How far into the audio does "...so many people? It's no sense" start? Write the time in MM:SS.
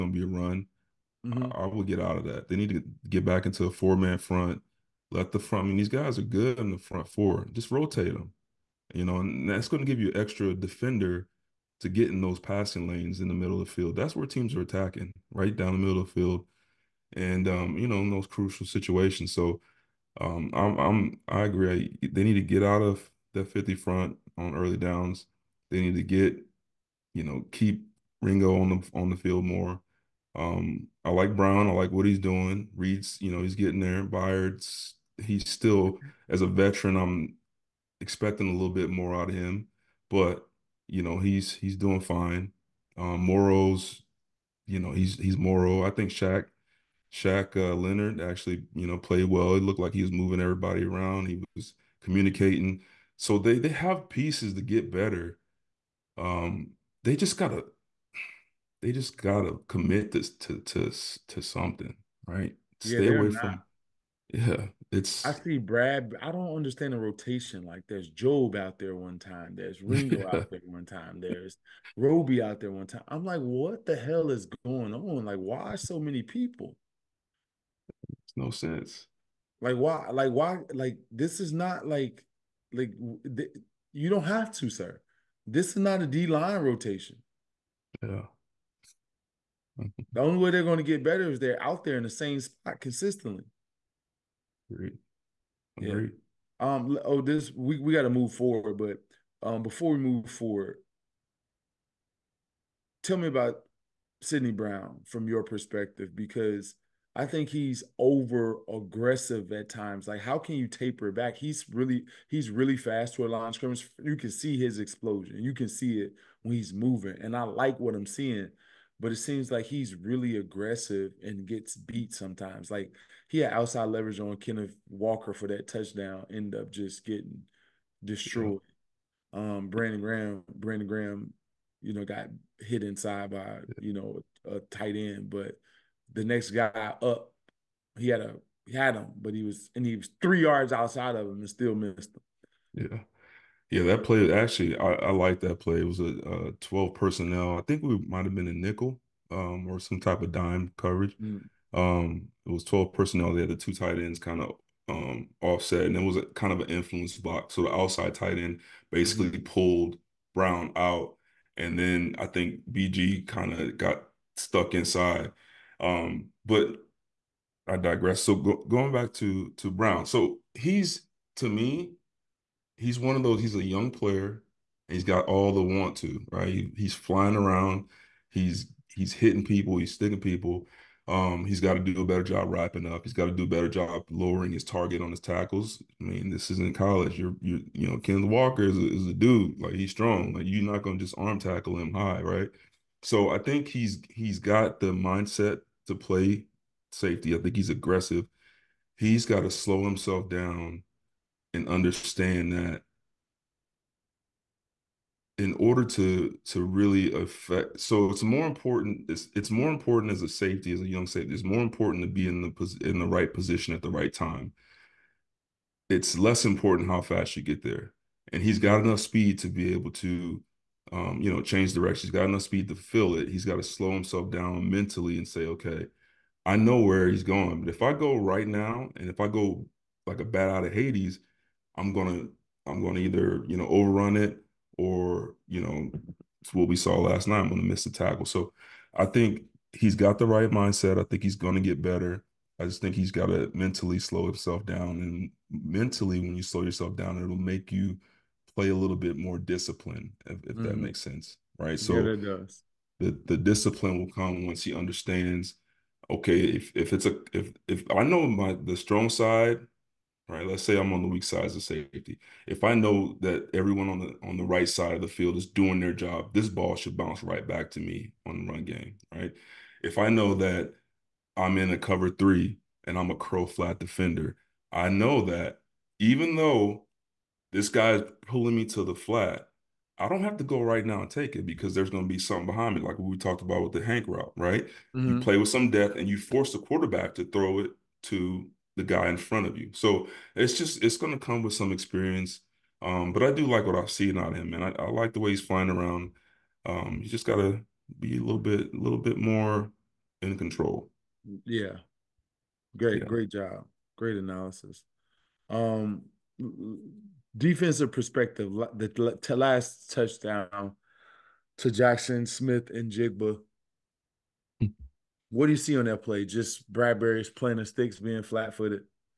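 01:15.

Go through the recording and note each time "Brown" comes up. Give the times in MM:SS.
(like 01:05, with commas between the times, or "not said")
00:31, 01:44, 02:40, 02:49.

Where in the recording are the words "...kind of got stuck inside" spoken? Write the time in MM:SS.
02:43.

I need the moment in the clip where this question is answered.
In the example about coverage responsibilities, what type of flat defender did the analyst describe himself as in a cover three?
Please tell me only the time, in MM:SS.
04:33.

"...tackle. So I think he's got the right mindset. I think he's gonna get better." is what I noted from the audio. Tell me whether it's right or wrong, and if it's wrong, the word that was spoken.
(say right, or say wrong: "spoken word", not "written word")
right.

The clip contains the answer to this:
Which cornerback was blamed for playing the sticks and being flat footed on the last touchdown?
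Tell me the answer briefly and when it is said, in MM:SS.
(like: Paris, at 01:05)
Bradberry, at 05:16.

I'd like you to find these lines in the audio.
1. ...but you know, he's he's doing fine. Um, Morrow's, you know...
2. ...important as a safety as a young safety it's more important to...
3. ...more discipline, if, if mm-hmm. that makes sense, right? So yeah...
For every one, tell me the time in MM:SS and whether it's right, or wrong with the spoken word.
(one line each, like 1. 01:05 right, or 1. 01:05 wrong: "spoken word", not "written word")
1. 00:40 right
2. 03:29 right
3. 04:09 right.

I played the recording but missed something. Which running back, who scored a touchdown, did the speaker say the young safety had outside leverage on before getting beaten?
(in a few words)
Kenneth Walker.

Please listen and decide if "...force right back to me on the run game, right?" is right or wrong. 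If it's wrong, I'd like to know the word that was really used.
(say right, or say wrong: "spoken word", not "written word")
wrong: "bounce", not "force".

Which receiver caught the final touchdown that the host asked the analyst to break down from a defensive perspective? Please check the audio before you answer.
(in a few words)
Jaxon Smith-Njigba.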